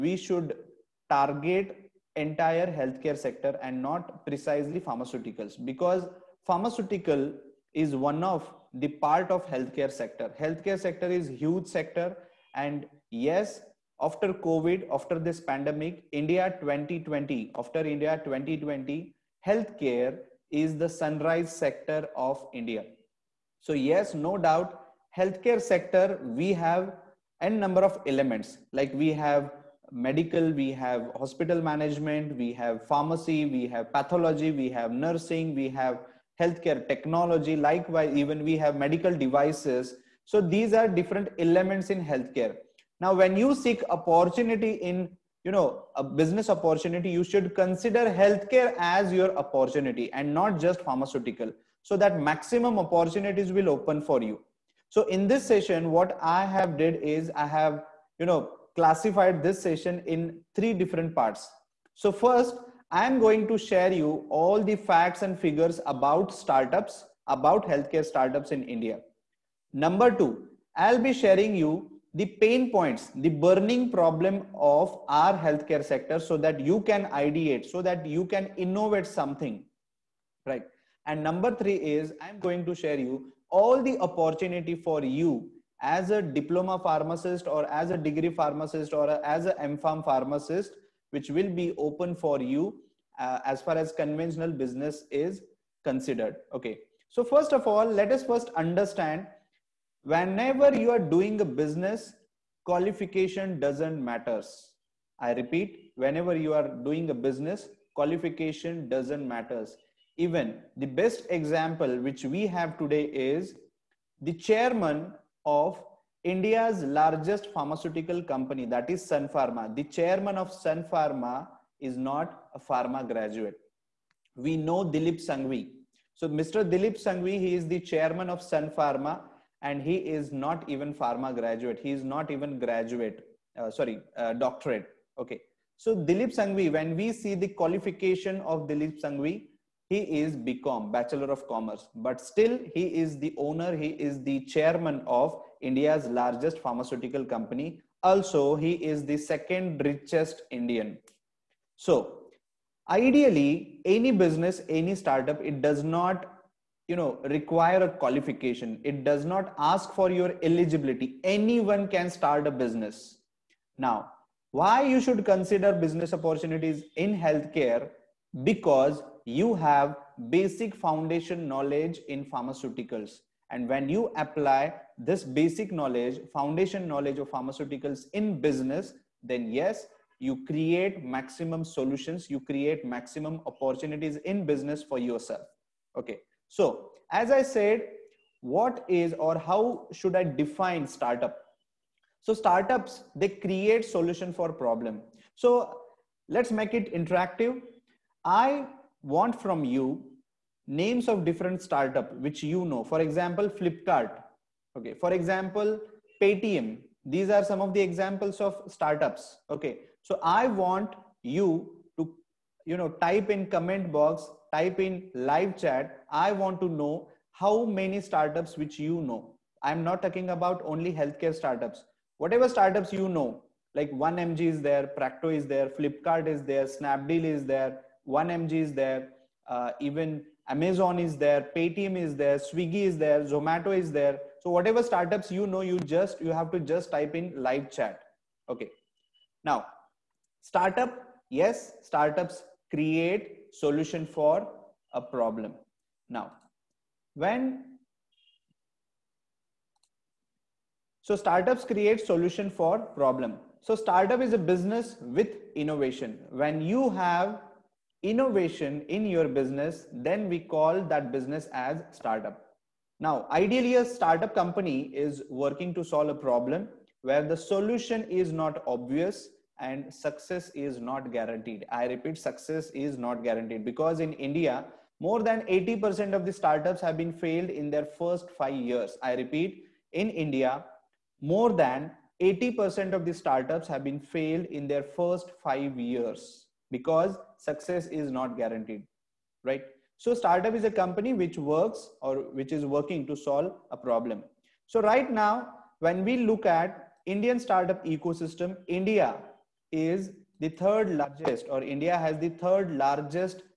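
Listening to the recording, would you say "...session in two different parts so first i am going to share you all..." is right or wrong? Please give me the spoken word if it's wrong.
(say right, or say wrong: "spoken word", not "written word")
wrong: "three", not "two".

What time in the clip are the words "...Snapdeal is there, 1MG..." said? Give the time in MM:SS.
03:46.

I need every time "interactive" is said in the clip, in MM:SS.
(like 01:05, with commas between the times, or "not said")
03:16.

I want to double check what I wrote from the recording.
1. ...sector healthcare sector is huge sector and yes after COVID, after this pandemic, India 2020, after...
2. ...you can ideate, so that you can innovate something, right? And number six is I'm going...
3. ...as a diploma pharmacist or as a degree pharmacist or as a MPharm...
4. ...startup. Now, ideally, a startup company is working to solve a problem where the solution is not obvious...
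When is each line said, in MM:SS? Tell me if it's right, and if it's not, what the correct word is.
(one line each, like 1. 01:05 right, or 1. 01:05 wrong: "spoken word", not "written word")
1. 00:09 right
2. 01:16 wrong: "three", not "six"
3. 01:25 right
4. 04:21 right.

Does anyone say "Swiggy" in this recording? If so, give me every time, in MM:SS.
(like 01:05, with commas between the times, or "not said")
03:52.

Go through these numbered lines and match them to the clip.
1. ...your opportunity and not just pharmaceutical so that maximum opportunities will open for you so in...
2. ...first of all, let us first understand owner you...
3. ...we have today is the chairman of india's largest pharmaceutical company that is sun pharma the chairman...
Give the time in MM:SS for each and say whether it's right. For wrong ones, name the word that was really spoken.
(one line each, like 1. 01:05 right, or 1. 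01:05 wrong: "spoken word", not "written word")
1. 00:49 right
2. 01:37 wrong: "whenever", not "owner"
3. 01:52 right.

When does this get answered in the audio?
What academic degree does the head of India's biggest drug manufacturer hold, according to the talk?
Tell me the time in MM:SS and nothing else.
02:20.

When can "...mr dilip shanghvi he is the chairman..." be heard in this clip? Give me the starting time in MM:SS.
02:06.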